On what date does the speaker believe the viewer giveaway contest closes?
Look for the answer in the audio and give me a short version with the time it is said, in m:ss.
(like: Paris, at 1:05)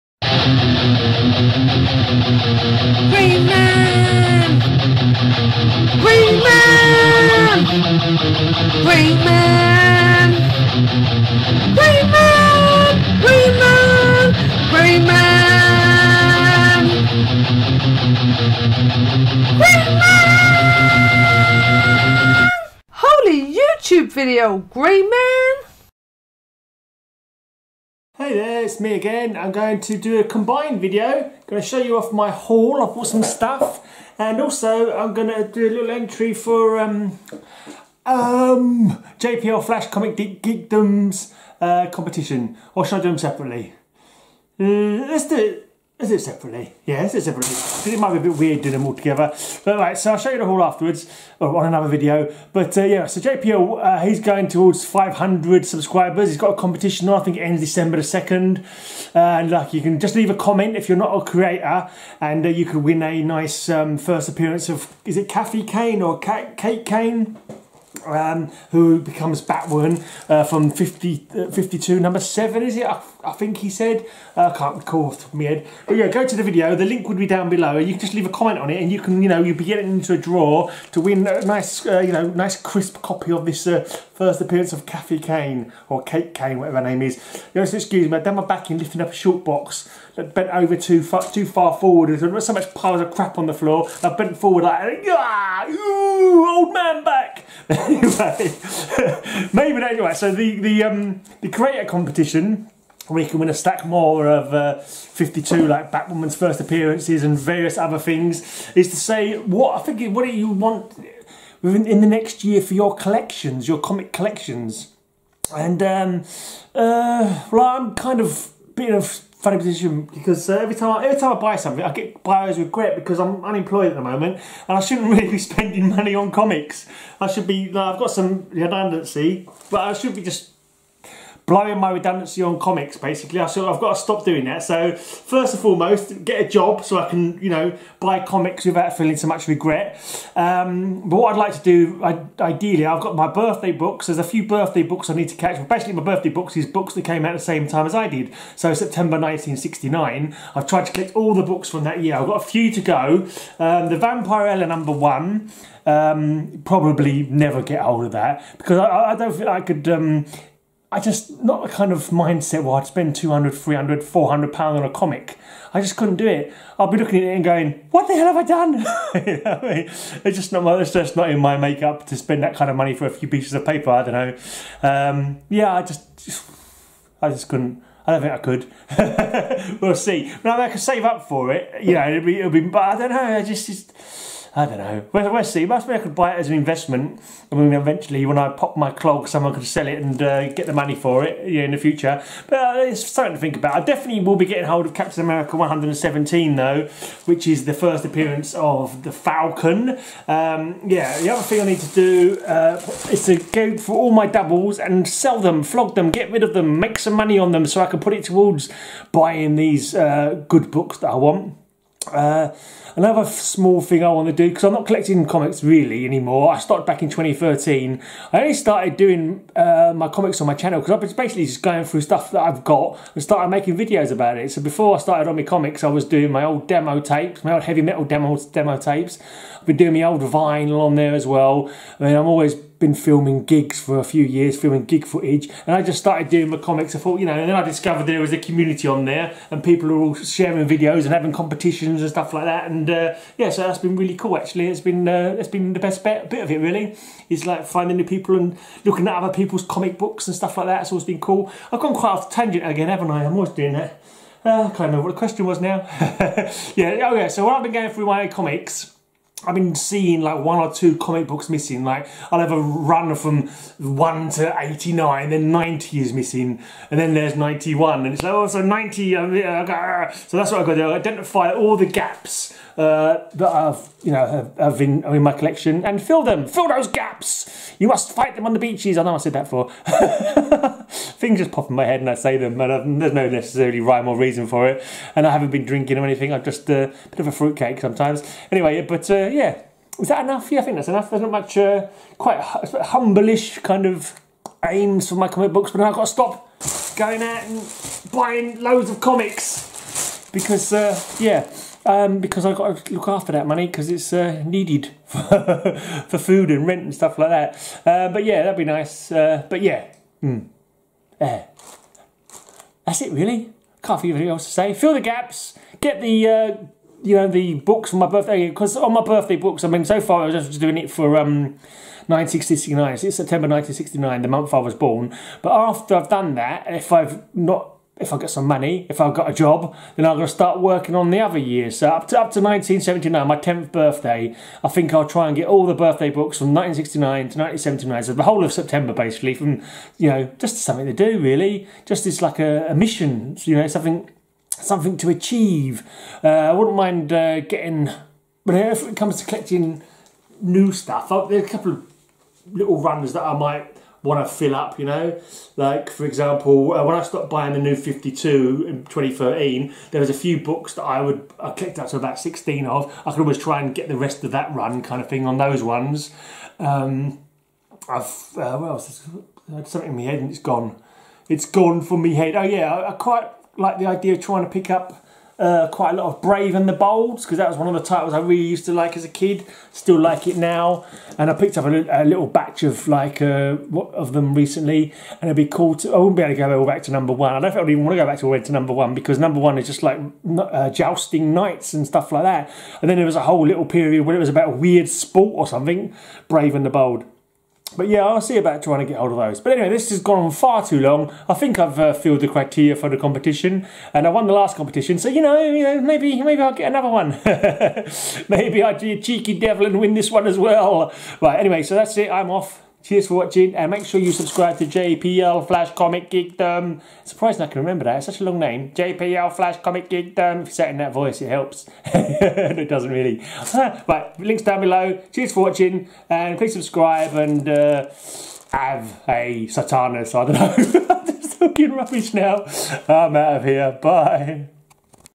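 December 2nd, at 0:57.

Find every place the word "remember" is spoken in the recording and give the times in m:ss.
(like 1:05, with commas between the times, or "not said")
4:14, 6:57.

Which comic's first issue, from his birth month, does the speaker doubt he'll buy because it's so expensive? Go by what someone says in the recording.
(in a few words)
Vampirella.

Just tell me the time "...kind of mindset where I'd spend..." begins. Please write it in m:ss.
2:41.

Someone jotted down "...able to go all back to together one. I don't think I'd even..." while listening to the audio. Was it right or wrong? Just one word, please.
wrong.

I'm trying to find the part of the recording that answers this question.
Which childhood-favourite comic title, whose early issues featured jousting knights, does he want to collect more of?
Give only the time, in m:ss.
6:16.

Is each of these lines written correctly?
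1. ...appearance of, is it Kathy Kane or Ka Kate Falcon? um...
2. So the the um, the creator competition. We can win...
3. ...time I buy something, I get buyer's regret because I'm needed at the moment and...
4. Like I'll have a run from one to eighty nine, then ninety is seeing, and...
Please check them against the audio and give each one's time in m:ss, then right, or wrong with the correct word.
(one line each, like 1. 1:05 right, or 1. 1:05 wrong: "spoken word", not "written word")
1. 1:04 wrong: "Kane", not "Falcon"
2. 1:40 right
3. 2:01 wrong: "unemployed", not "needed"
4. 4:21 wrong: "missing", not "seeing".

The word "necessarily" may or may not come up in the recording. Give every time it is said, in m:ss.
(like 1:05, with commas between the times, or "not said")
4:43.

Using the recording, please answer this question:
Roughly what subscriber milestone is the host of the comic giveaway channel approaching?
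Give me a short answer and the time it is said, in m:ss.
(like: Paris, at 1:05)
500, at 0:54.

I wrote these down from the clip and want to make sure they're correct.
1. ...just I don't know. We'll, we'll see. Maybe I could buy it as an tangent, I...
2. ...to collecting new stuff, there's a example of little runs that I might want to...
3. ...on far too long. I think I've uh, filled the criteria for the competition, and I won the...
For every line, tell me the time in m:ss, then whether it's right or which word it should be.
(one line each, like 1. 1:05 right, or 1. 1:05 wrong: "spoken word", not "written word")
1. 3:03 wrong: "investment", not "tangent"
2. 5:49 wrong: "couple", not "example"
3. 6:40 right.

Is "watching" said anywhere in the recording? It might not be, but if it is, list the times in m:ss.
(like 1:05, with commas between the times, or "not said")
6:53, 7:05.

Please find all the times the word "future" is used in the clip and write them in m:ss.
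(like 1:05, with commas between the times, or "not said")
3:11.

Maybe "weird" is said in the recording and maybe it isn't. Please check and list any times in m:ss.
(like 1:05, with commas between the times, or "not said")
0:48, 6:34.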